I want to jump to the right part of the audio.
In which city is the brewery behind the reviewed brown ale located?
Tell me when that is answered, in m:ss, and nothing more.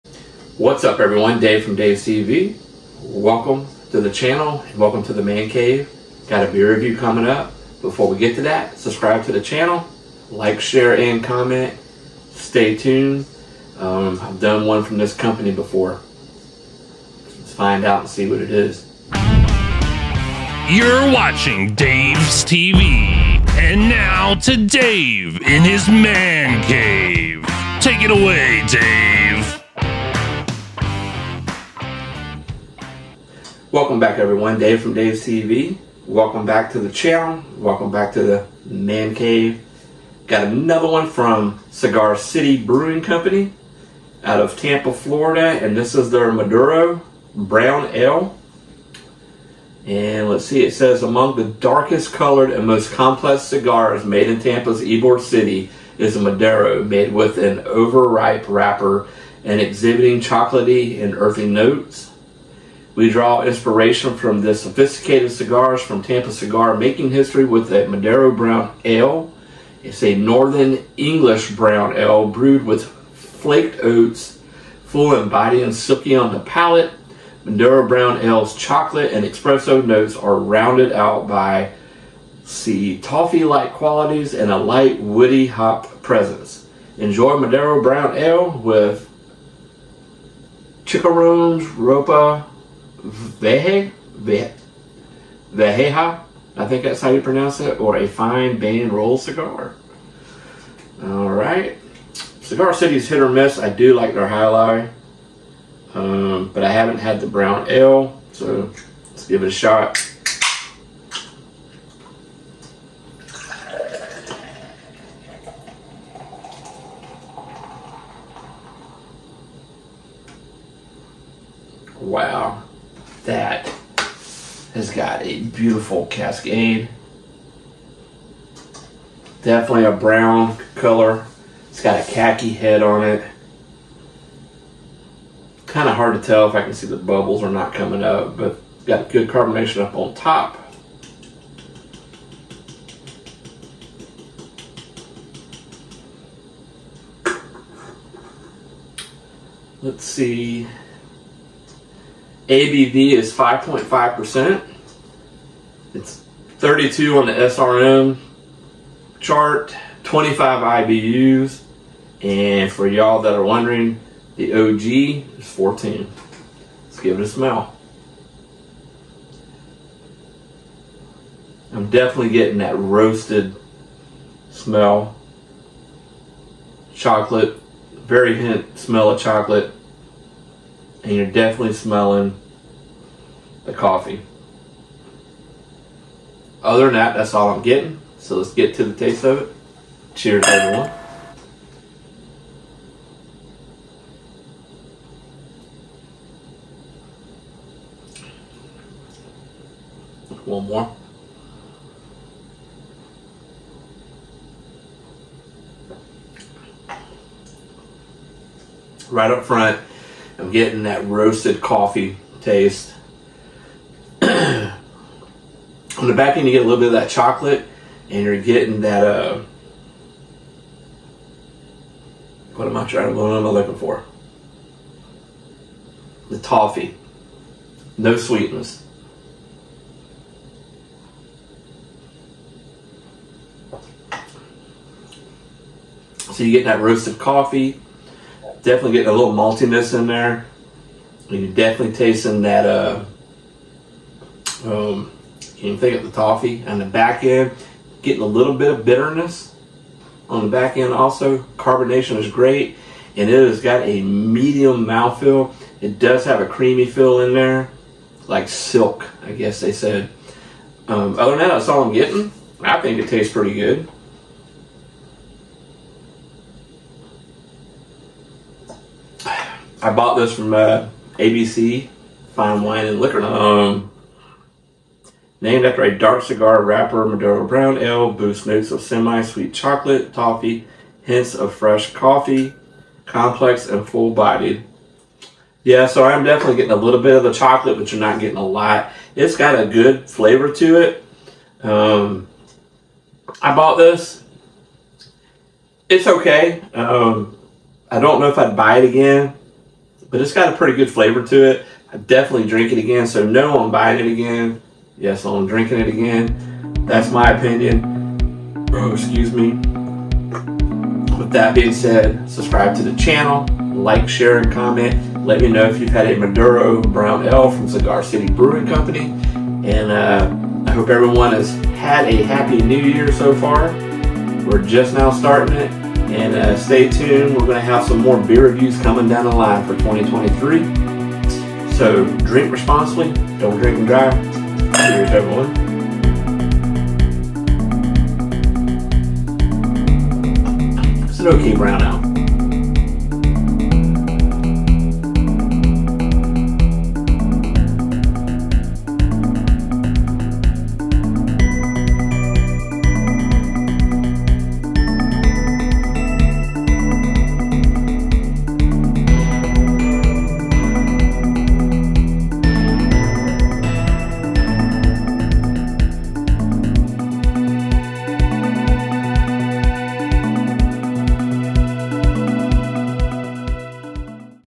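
0:44.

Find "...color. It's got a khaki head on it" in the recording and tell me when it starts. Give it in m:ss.
2:10.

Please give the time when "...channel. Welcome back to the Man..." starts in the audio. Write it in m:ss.
0:36.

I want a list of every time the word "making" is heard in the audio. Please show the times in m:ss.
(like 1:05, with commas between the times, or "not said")
1:06.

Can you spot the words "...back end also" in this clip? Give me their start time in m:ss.
4:10.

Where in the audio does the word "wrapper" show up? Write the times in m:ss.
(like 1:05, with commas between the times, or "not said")
0:58, 4:36.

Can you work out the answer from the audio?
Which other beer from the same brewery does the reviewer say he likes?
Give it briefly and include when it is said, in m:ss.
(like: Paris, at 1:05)
Jai Alai, at 1:44.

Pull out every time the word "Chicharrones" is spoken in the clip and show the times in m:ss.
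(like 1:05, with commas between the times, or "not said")
1:30.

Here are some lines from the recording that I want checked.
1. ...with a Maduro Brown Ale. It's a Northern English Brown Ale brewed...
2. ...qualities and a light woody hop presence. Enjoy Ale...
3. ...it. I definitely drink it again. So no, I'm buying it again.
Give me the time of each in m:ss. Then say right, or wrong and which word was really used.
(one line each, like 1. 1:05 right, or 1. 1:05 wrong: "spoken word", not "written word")
1. 1:07 right
2. 1:23 wrong: "Maduro", not "Ale"
3. 5:01 right.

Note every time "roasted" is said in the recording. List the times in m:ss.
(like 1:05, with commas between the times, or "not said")
2:52, 3:31, 3:56.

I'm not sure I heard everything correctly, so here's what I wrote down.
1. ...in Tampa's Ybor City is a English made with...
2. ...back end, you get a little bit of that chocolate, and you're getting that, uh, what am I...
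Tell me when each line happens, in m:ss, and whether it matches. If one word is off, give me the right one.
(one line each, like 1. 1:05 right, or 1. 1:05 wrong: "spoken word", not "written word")
1. 0:54 wrong: "Maduro", not "English"
2. 3:36 right.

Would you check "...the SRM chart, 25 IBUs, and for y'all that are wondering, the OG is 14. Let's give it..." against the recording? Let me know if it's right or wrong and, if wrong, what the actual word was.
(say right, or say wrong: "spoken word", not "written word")
right.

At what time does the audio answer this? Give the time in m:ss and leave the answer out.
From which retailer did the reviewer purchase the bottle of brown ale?
4:31.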